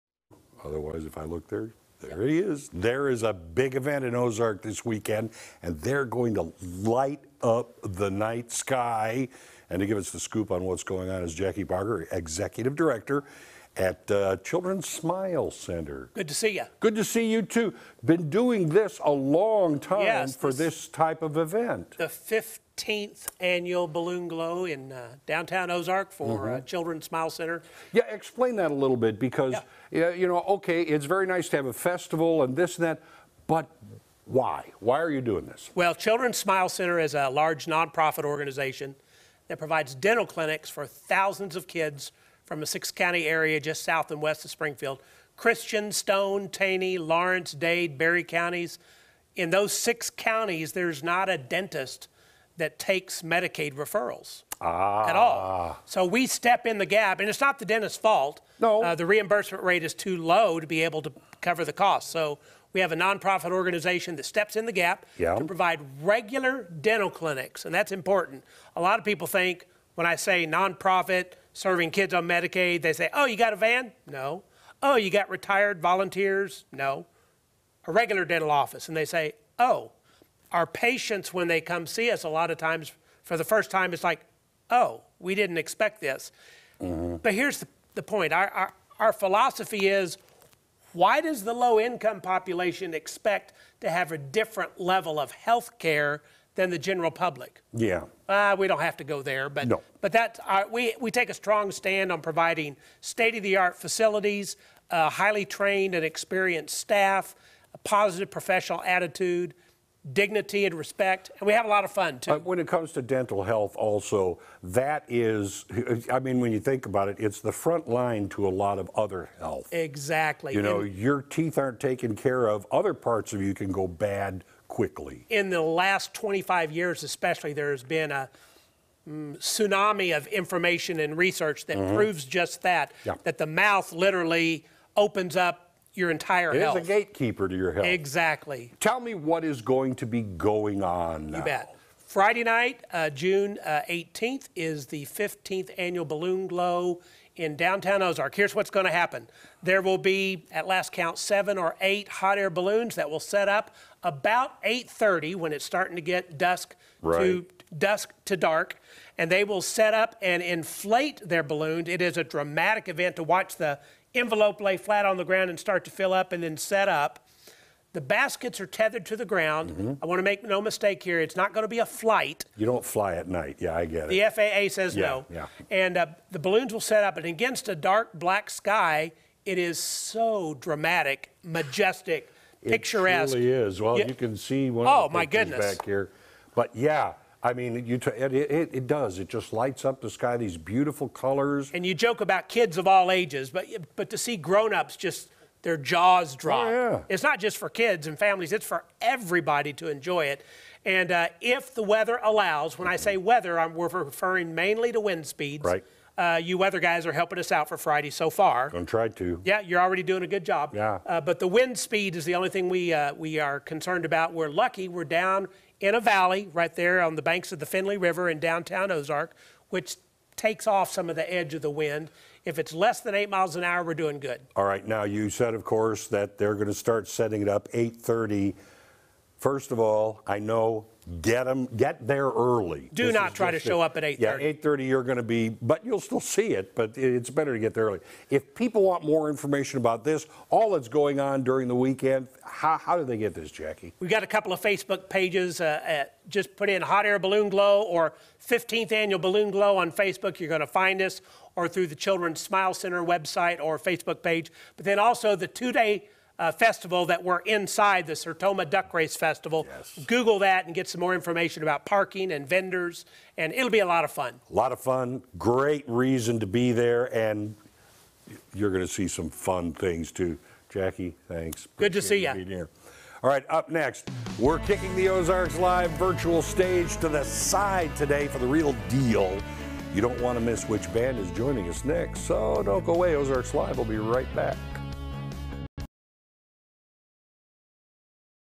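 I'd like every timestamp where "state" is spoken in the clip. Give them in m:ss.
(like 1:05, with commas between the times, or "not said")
1:43.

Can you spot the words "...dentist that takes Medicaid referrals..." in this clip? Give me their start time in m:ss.
0:51.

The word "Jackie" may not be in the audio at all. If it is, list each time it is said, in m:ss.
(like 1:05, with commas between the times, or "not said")
0:11, 4:03, 4:30.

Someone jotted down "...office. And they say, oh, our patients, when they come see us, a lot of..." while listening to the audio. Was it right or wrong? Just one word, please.
right.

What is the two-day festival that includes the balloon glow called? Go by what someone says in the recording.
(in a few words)
Sertoma Duck Race Festival.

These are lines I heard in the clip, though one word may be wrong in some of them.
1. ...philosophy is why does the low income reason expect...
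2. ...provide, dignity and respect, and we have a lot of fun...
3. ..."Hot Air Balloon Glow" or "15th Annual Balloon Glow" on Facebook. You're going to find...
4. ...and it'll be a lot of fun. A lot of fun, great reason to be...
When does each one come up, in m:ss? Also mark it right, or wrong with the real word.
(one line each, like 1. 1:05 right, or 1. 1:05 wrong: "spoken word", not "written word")
1. 1:29 wrong: "population", not "reason"
2. 1:48 wrong: "attitude", not "provide"
3. 4:06 right
4. 4:23 right.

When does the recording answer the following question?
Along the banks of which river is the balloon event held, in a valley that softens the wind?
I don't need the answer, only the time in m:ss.
3:37.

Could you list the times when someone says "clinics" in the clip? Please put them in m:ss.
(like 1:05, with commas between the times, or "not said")
0:40, 1:07.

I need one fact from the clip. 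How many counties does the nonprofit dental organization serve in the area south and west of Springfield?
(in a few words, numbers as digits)
6.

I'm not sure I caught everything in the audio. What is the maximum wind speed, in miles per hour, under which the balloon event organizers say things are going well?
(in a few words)
8.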